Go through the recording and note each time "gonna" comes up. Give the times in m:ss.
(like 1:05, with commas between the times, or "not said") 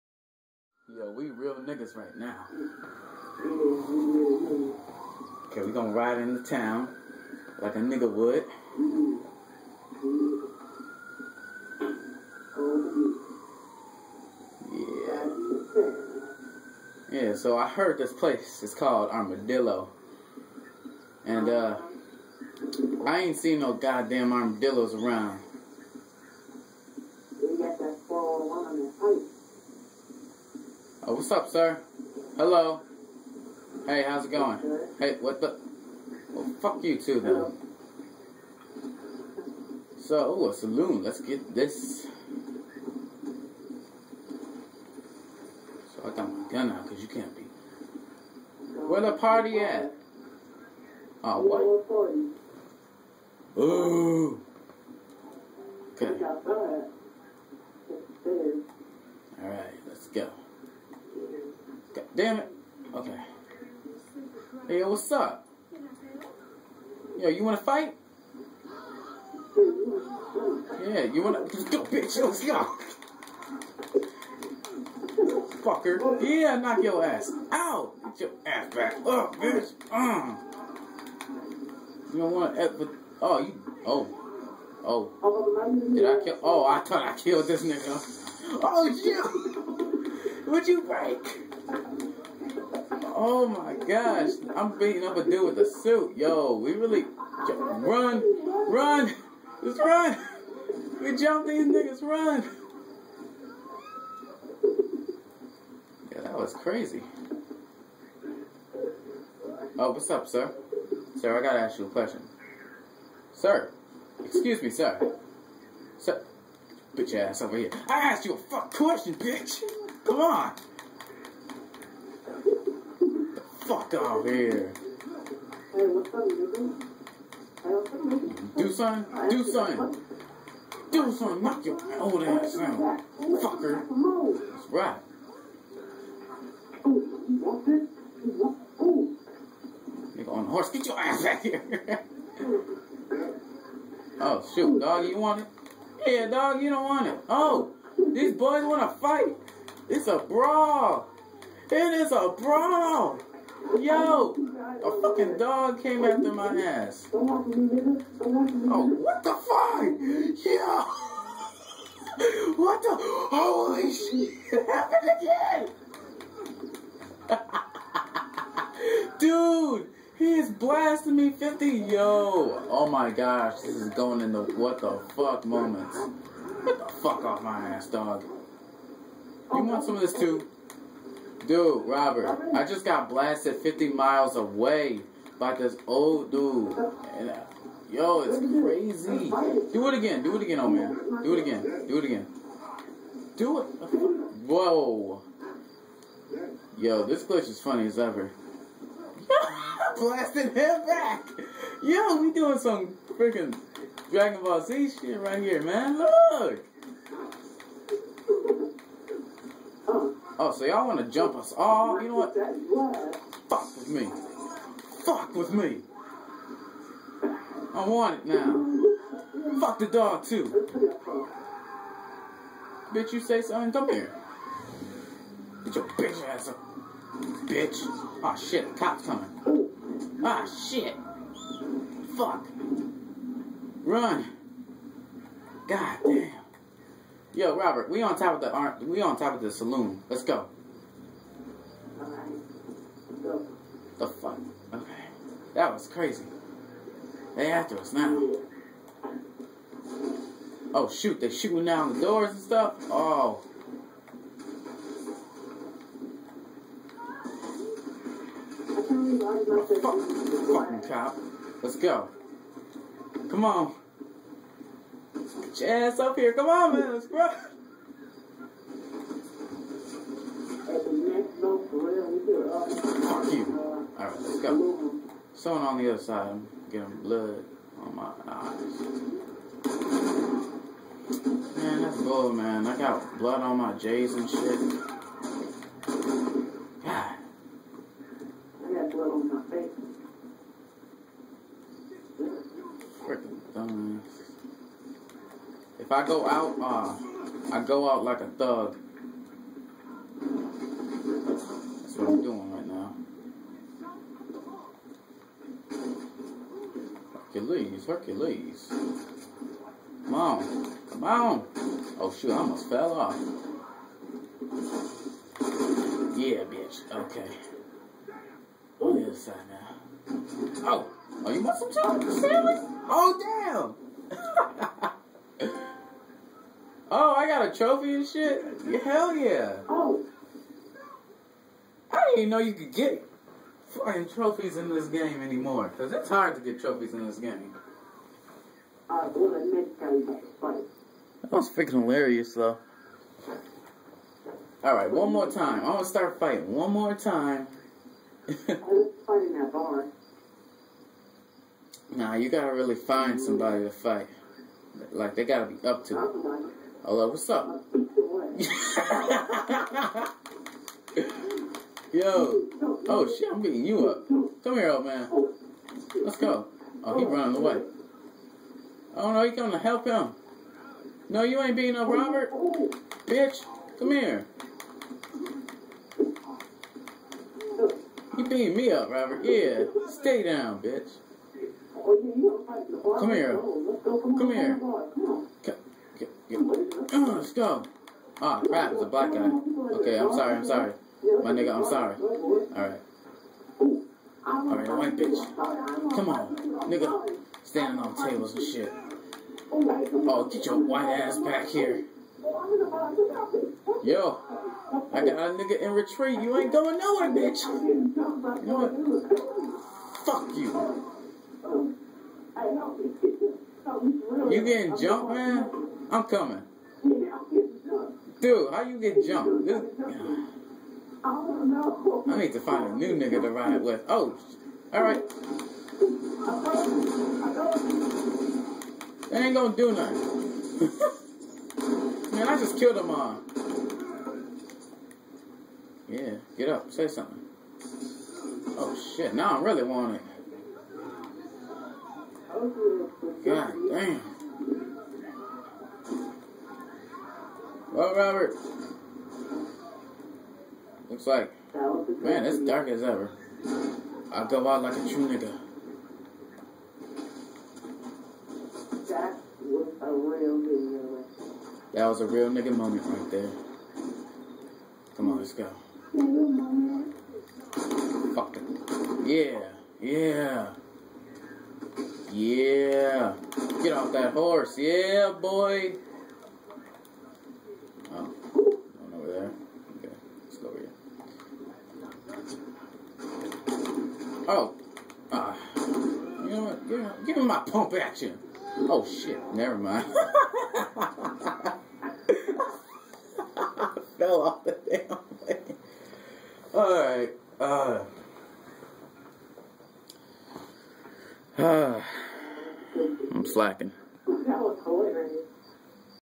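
0:05, 7:09.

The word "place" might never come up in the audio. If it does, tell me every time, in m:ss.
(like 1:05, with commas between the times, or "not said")
0:18.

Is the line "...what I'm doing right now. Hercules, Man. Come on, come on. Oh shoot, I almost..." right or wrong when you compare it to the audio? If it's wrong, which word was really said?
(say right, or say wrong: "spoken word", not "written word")
wrong: "Hercules", not "Man".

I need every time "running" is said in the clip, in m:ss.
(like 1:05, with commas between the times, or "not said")
6:07.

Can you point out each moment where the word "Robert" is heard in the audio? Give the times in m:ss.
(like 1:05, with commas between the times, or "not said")
3:01, 3:57, 6:11, 6:18, 7:27.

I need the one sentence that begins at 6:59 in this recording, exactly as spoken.
This, I need to find a new nigga to ride with.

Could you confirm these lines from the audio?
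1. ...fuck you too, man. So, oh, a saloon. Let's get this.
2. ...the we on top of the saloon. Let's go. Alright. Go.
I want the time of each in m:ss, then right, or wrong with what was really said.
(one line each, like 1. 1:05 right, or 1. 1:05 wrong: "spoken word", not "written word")
1. 0:36 right
2. 3:58 right.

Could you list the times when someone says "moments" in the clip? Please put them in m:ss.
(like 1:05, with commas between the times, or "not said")
2:55, 7:42.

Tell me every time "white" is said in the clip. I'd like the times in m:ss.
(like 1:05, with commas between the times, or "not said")
6:34, 6:40.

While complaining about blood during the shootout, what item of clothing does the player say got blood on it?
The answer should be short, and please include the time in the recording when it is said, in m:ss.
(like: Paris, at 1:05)
J's, at 4:43.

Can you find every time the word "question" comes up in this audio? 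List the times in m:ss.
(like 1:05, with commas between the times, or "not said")
1:51, 1:58.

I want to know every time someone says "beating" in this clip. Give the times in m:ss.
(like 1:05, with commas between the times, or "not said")
1:34, 6:03, 6:11, 6:18.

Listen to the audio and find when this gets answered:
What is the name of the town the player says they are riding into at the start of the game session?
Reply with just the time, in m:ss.
0:19.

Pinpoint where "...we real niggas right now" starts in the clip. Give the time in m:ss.
0:01.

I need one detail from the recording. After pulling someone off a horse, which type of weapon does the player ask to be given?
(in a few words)
pump action.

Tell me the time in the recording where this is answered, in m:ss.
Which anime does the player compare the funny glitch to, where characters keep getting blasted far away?
3:24.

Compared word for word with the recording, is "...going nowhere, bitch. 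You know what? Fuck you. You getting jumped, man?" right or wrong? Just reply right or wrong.
right.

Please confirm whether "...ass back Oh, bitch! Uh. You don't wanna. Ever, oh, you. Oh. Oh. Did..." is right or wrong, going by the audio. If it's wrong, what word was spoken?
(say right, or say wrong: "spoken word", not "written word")
right.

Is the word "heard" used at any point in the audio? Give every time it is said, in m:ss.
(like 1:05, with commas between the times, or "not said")
0:17.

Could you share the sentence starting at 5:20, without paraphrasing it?
Oh, oh, you want some chocolate sandwich?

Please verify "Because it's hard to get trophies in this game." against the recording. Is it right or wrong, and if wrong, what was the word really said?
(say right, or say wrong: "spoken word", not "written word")
right.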